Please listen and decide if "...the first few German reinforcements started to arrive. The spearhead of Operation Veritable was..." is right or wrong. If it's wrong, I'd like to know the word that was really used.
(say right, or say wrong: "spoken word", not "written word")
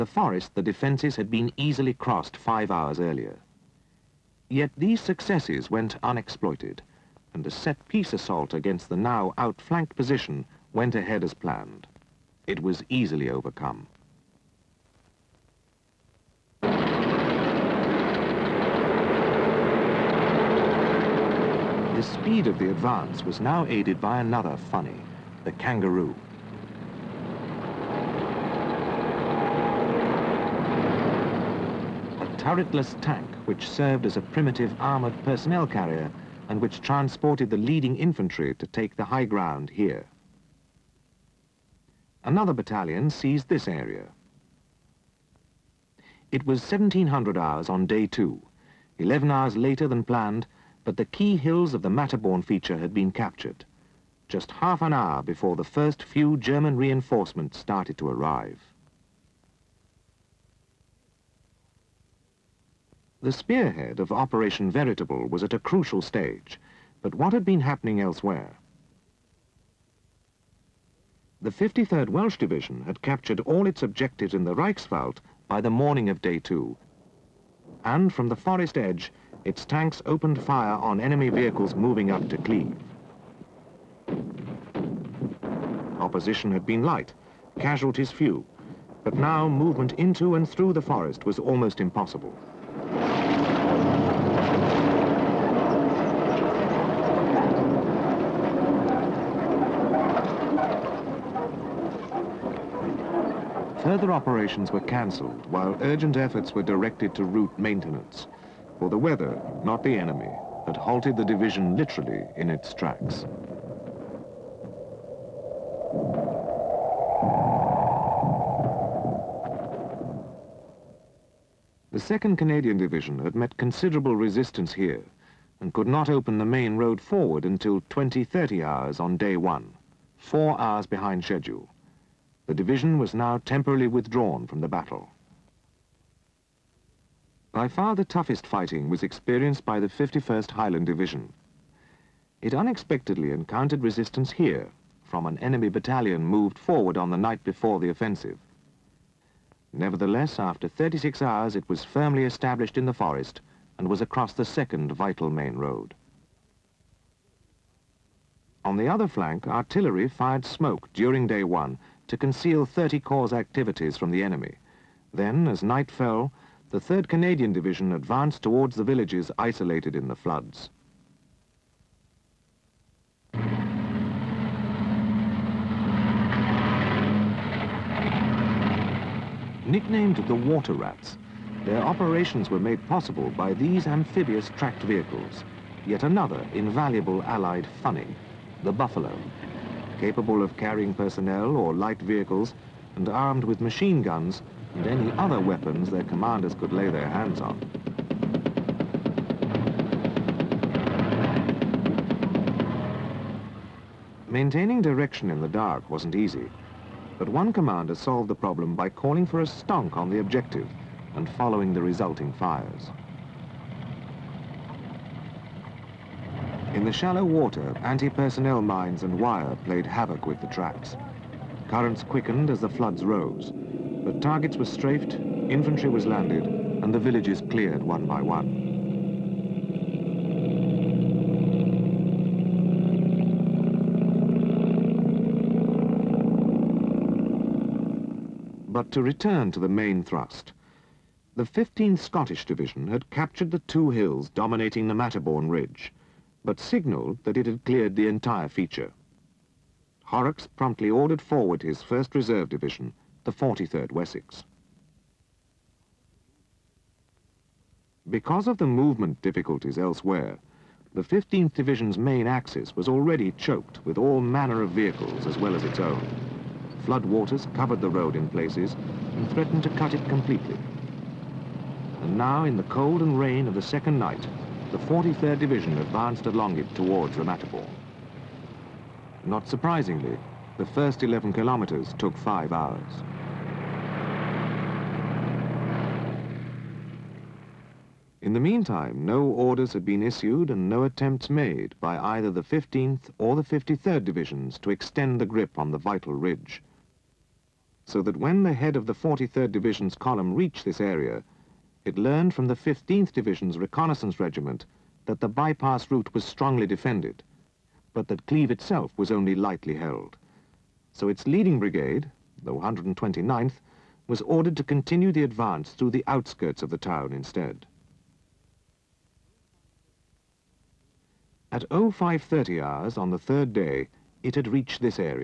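right.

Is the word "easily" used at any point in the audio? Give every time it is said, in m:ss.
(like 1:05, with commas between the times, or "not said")
0:01, 0:12.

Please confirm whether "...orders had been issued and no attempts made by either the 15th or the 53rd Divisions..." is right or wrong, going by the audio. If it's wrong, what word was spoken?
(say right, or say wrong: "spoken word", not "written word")
right.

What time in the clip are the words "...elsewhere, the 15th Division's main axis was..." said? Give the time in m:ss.
4:19.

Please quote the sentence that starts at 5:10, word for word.
So its leading brigade, the 129th, was ordered to continue the advance through the outskirts of the town instead.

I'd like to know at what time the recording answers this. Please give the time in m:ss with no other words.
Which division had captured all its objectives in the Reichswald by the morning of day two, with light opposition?
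1:11.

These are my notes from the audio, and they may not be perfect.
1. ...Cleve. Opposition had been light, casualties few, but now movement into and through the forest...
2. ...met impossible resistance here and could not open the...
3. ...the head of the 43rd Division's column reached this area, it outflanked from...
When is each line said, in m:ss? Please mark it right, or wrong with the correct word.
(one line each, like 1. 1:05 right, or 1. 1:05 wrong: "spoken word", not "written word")
1. 1:22 right
2. 2:03 wrong: "considerable", not "impossible"
3. 4:58 wrong: "learned", not "outflanked".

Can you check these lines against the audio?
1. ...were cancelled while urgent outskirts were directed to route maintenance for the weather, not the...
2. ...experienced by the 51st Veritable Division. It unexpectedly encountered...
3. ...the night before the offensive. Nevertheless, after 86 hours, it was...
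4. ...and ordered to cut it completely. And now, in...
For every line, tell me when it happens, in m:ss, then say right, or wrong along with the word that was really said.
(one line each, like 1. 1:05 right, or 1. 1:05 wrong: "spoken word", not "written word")
1. 1:44 wrong: "efforts", not "outskirts"
2. 2:19 wrong: "Highland", not "Veritable"
3. 2:27 wrong: "36", not "86"
4. 4:29 wrong: "threatened", not "ordered".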